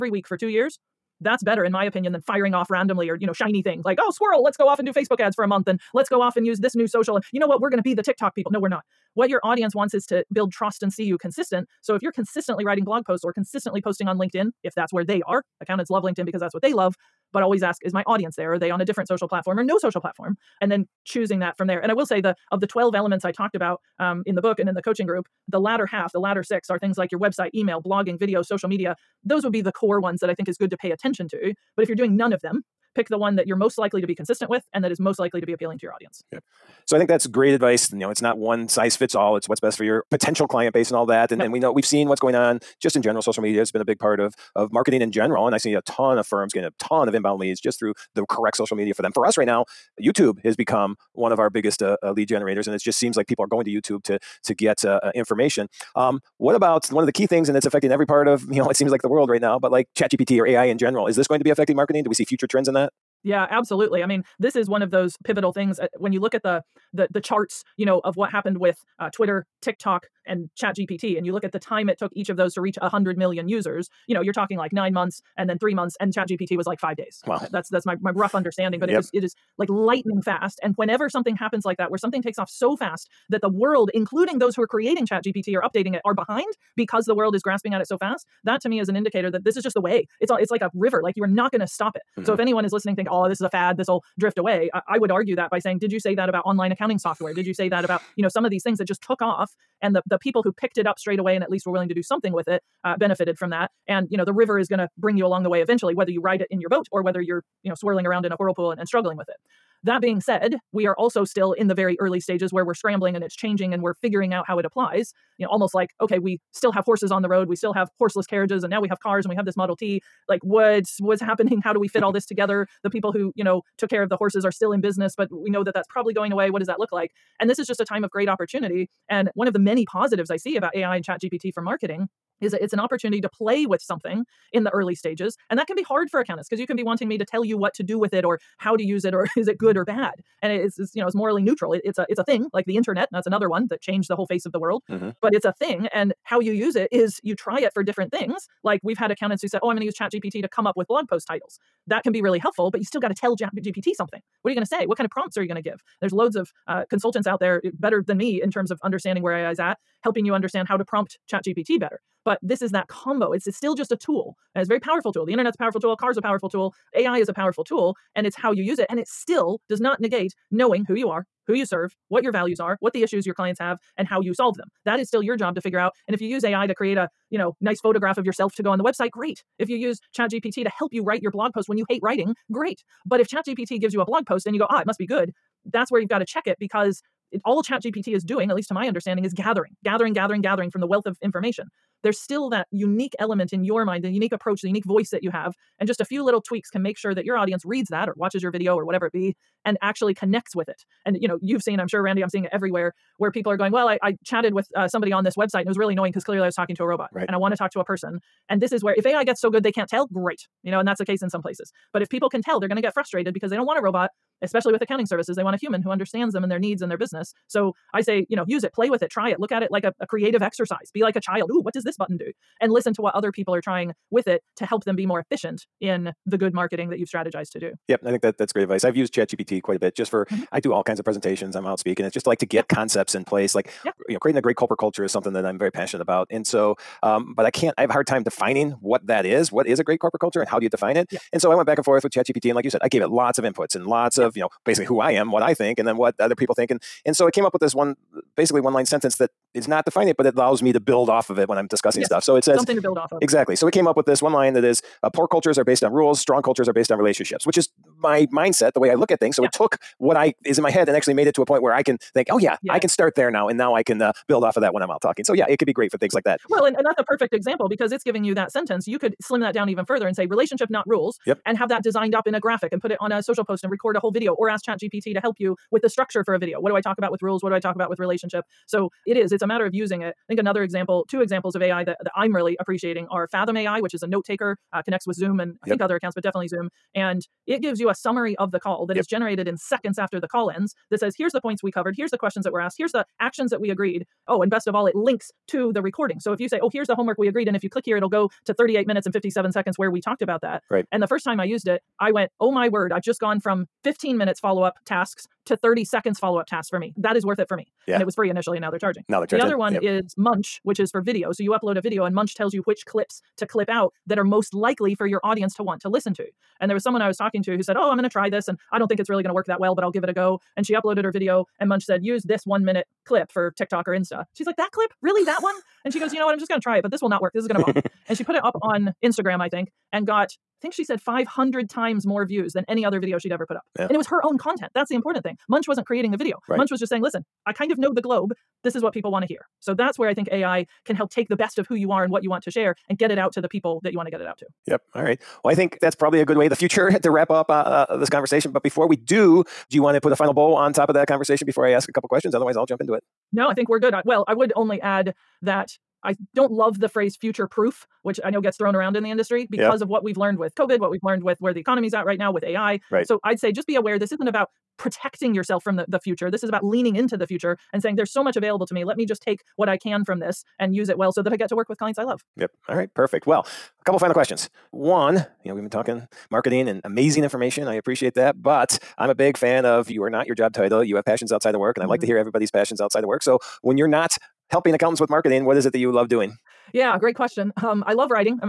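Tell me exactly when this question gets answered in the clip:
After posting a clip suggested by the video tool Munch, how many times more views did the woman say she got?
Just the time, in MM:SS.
05:30.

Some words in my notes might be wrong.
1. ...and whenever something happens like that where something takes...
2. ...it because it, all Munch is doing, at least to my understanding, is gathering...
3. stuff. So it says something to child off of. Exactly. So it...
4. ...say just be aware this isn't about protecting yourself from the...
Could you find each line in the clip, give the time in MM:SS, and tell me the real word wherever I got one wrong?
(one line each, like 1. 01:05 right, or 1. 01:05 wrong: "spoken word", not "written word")
1. 01:20 right
2. 03:06 wrong: "ChatGPT", not "Munch"
3. 04:12 wrong: "build", not "child"
4. 06:03 right.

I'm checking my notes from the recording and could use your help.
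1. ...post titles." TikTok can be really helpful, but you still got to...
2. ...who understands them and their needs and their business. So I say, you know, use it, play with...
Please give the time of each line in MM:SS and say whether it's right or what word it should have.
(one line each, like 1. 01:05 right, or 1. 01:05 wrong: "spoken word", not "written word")
1. 02:31 wrong: "That", not "TikTok"
2. 03:35 right.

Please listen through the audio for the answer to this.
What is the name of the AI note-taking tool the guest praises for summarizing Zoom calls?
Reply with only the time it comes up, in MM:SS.
04:43.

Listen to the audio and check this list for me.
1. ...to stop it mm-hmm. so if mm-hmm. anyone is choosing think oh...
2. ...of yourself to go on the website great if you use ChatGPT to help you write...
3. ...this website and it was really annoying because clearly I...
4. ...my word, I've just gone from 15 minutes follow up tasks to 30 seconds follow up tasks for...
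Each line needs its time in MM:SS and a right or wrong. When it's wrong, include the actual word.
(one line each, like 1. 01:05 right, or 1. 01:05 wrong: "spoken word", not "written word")
1. 01:31 wrong: "listening", not "choosing"
2. 02:58 right
3. 03:25 right
4. 05:02 right.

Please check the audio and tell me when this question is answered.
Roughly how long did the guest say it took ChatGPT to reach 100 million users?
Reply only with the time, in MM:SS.
01:16.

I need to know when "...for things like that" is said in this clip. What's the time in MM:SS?
04:25.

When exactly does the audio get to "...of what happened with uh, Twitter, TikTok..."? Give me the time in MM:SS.
01:08.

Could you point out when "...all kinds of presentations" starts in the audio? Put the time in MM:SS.
03:50.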